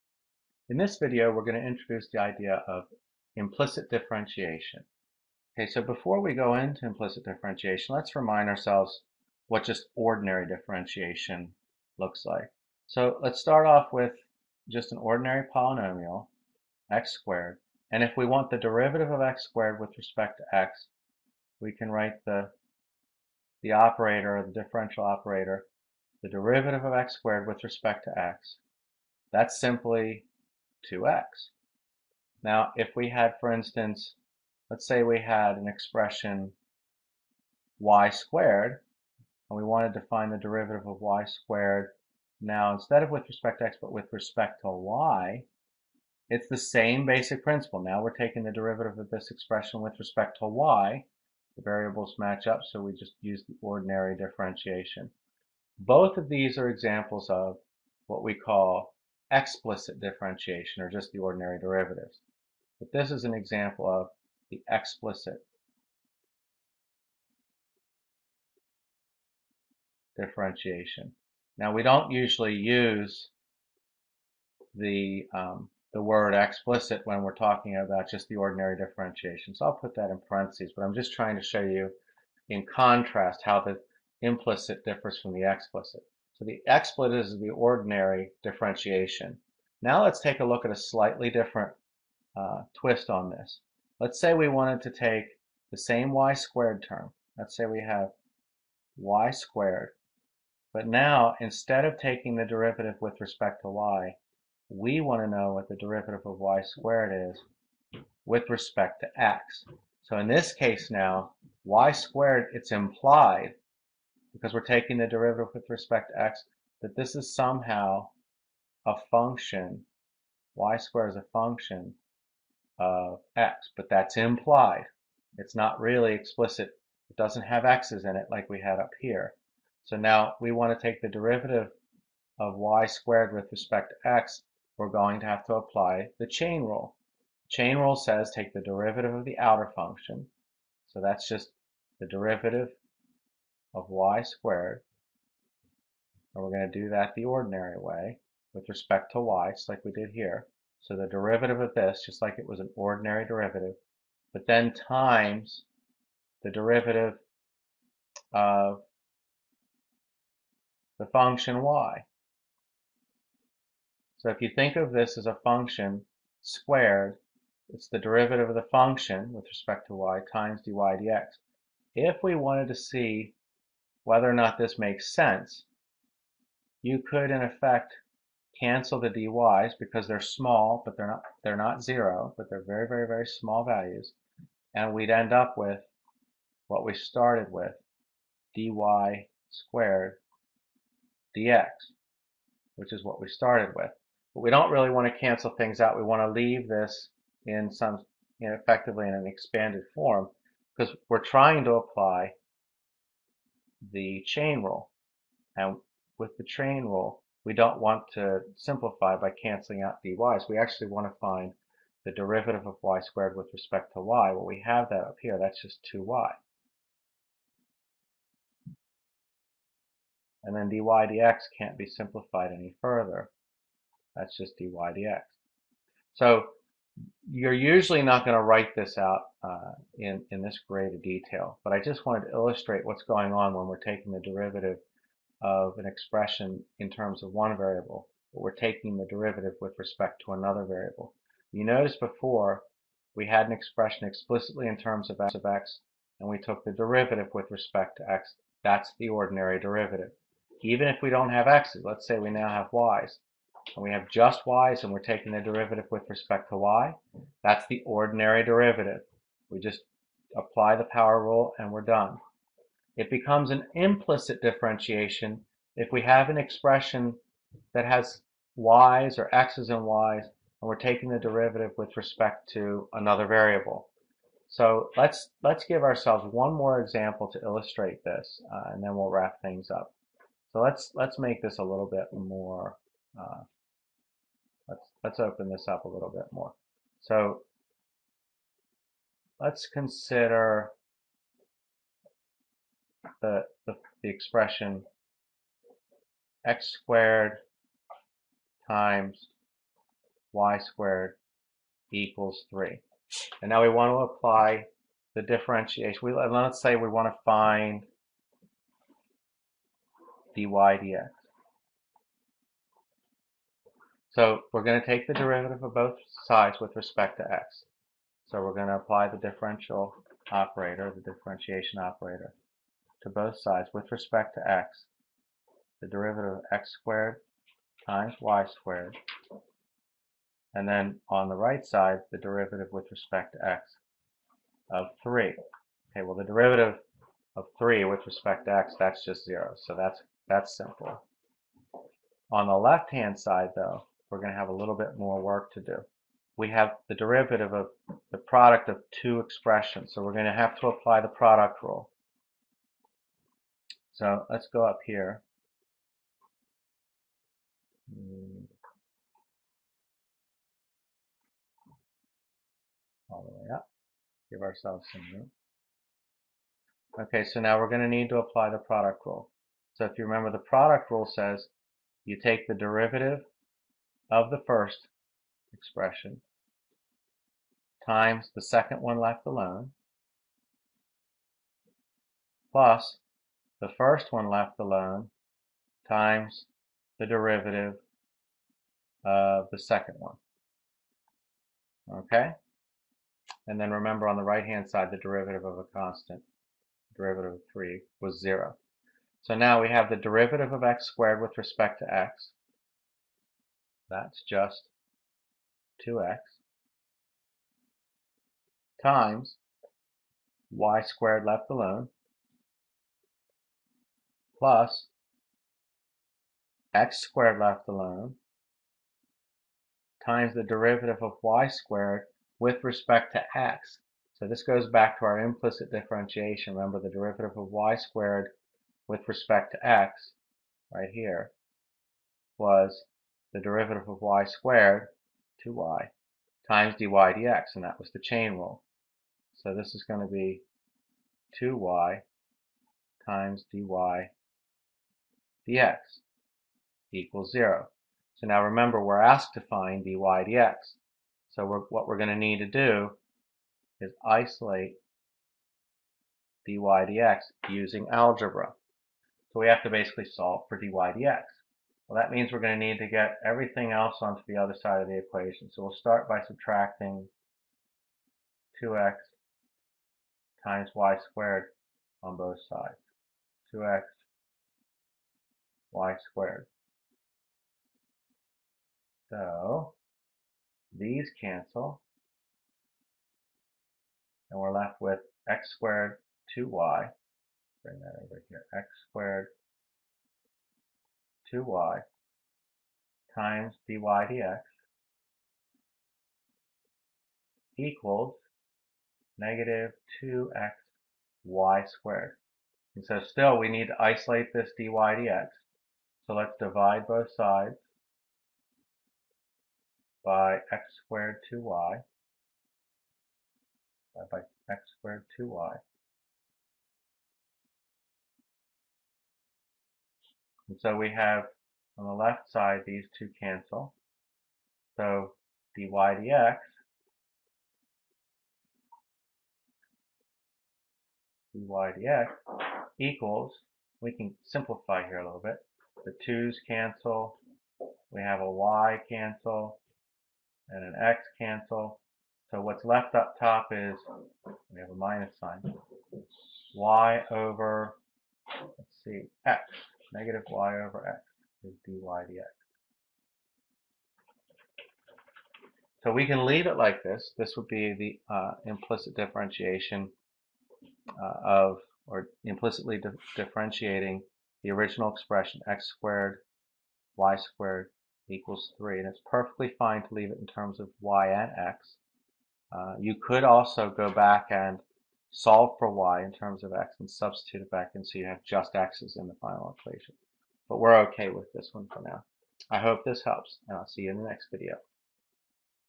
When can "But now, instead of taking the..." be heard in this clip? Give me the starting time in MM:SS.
01:40.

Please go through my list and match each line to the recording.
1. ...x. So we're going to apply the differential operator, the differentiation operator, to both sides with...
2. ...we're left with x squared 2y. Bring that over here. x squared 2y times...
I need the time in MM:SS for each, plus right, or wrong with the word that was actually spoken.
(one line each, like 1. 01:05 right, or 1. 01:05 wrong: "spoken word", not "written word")
1. 05:17 right
2. 08:04 right.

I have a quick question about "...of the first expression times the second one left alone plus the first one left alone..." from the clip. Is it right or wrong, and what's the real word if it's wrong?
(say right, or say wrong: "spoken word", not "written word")
right.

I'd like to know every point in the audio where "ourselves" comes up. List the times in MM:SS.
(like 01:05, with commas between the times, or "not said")
00:08, 04:35, 06:04.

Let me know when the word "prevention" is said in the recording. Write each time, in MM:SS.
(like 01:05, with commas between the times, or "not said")
not said.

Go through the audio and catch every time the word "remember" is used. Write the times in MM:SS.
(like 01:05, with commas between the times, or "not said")
06:10, 06:33, 07:06, 07:28.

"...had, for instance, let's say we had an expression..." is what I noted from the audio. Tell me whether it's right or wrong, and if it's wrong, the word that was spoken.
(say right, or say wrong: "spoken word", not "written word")
right.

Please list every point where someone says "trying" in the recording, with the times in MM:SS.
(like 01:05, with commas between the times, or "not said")
01:21, 03:21.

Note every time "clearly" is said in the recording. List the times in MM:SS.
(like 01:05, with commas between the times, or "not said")
not said.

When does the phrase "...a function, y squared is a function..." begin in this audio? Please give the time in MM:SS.
01:58.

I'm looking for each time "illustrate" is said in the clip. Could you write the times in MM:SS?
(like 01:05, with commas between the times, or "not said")
03:52, 04:37.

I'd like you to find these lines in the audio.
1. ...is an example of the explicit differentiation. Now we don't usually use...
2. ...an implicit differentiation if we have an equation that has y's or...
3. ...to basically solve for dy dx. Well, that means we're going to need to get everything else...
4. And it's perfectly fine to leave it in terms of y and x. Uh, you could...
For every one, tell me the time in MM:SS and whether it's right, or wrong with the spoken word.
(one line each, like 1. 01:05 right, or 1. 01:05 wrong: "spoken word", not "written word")
1. 01:03 right
2. 04:23 wrong: "expression", not "equation"
3. 07:39 right
4. 09:28 right.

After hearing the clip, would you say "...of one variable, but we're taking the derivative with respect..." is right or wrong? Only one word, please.
right.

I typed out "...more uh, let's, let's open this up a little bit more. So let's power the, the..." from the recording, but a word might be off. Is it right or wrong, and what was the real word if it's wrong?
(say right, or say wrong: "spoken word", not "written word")
wrong: "consider", not "power".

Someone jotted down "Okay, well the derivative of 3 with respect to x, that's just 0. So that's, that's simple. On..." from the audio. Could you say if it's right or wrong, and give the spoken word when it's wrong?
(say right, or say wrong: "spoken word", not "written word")
right.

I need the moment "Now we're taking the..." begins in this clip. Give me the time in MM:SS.
00:47.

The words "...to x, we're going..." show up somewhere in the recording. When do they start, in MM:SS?
02:14.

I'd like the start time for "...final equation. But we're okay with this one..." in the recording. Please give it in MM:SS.
09:39.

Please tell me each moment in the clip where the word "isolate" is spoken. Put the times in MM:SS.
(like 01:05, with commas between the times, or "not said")
07:34, 08:23.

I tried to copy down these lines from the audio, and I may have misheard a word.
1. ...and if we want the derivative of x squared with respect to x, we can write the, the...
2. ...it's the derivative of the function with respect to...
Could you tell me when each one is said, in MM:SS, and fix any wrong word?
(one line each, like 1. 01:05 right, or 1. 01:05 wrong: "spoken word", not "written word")
1. 00:17 right
2. 02:47 right.